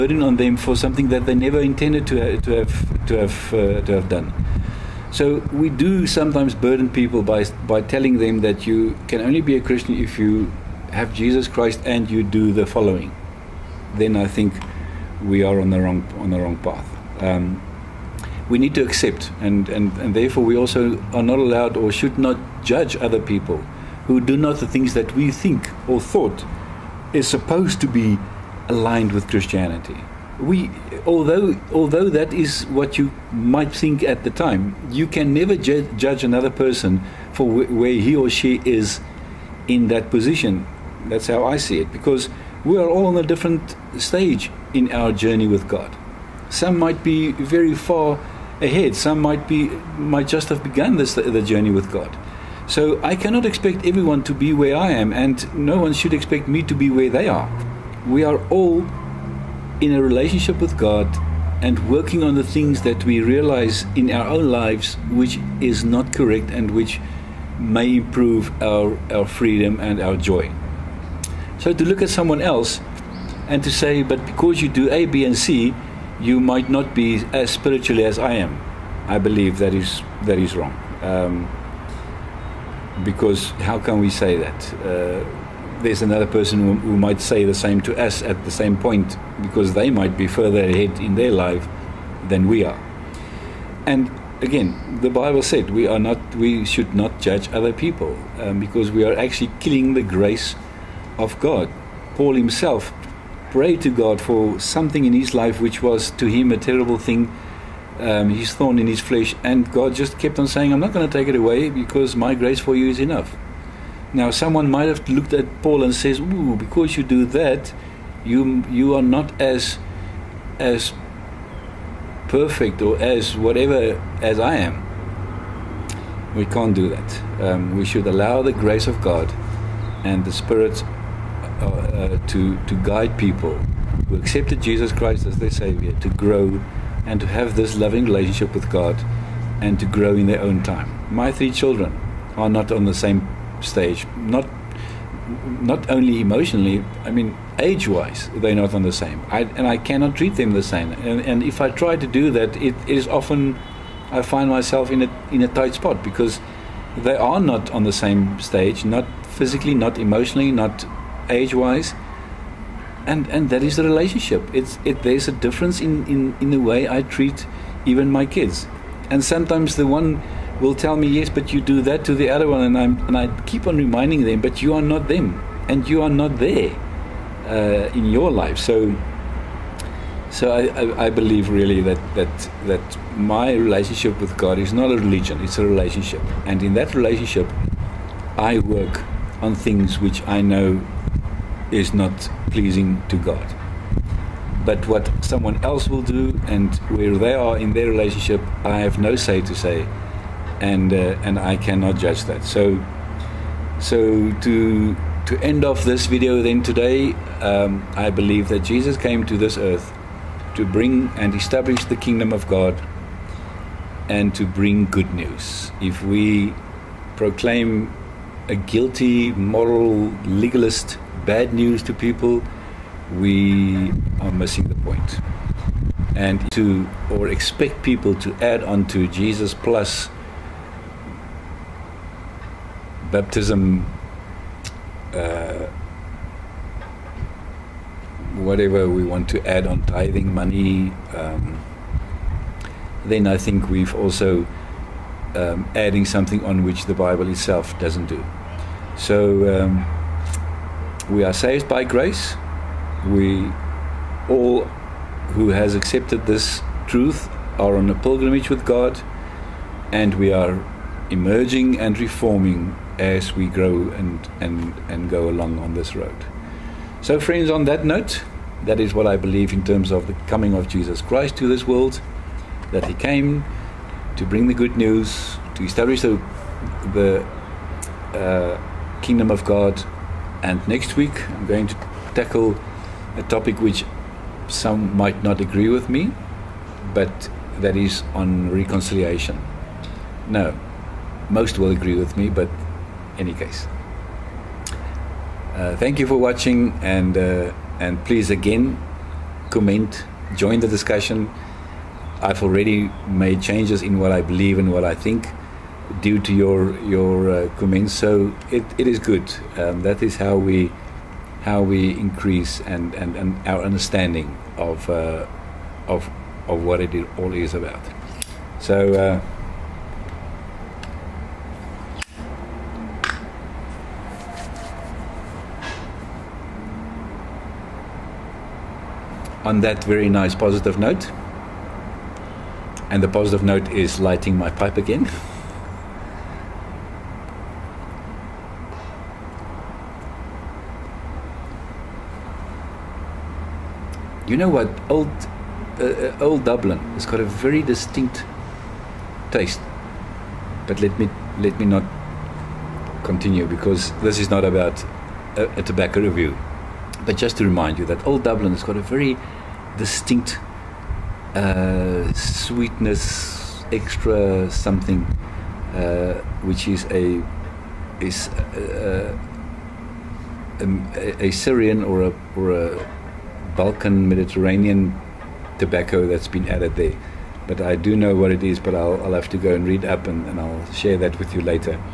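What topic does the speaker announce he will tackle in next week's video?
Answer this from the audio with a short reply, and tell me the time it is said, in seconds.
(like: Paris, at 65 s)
Reconciliation, at 288 s.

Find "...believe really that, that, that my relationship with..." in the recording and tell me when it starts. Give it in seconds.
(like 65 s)
181 s.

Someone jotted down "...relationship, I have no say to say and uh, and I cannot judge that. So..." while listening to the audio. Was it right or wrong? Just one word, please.
right.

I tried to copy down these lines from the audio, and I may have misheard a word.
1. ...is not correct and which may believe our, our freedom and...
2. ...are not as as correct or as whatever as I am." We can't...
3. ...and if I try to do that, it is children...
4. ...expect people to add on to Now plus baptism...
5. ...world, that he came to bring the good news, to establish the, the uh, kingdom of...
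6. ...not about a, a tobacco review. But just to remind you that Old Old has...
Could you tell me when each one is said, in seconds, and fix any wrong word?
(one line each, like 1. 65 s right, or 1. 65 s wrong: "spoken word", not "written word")
1. 65 s wrong: "improve", not "believe"
2. 118 s wrong: "perfect", not "correct"
3. 151 s wrong: "often", not "children"
4. 227 s wrong: "Jesus", not "Now"
5. 271 s right
6. 354 s wrong: "Dublin", not "Old".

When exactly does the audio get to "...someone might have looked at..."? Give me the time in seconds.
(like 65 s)
114 s.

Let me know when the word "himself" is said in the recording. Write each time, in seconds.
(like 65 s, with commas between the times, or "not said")
102 s.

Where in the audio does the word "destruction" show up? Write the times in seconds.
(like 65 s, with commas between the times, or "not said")
not said.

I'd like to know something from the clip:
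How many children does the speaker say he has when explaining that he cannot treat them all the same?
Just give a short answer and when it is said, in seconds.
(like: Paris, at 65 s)
3, at 141 s.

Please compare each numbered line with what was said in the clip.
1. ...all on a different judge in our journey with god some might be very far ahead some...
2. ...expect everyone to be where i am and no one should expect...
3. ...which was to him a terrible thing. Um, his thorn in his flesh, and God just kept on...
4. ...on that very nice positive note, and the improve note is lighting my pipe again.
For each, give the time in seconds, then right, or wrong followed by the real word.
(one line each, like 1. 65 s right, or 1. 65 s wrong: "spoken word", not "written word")
1. 42 s wrong: "stage", not "judge"
2. 53 s right
3. 105 s right
4. 329 s wrong: "positive", not "improve".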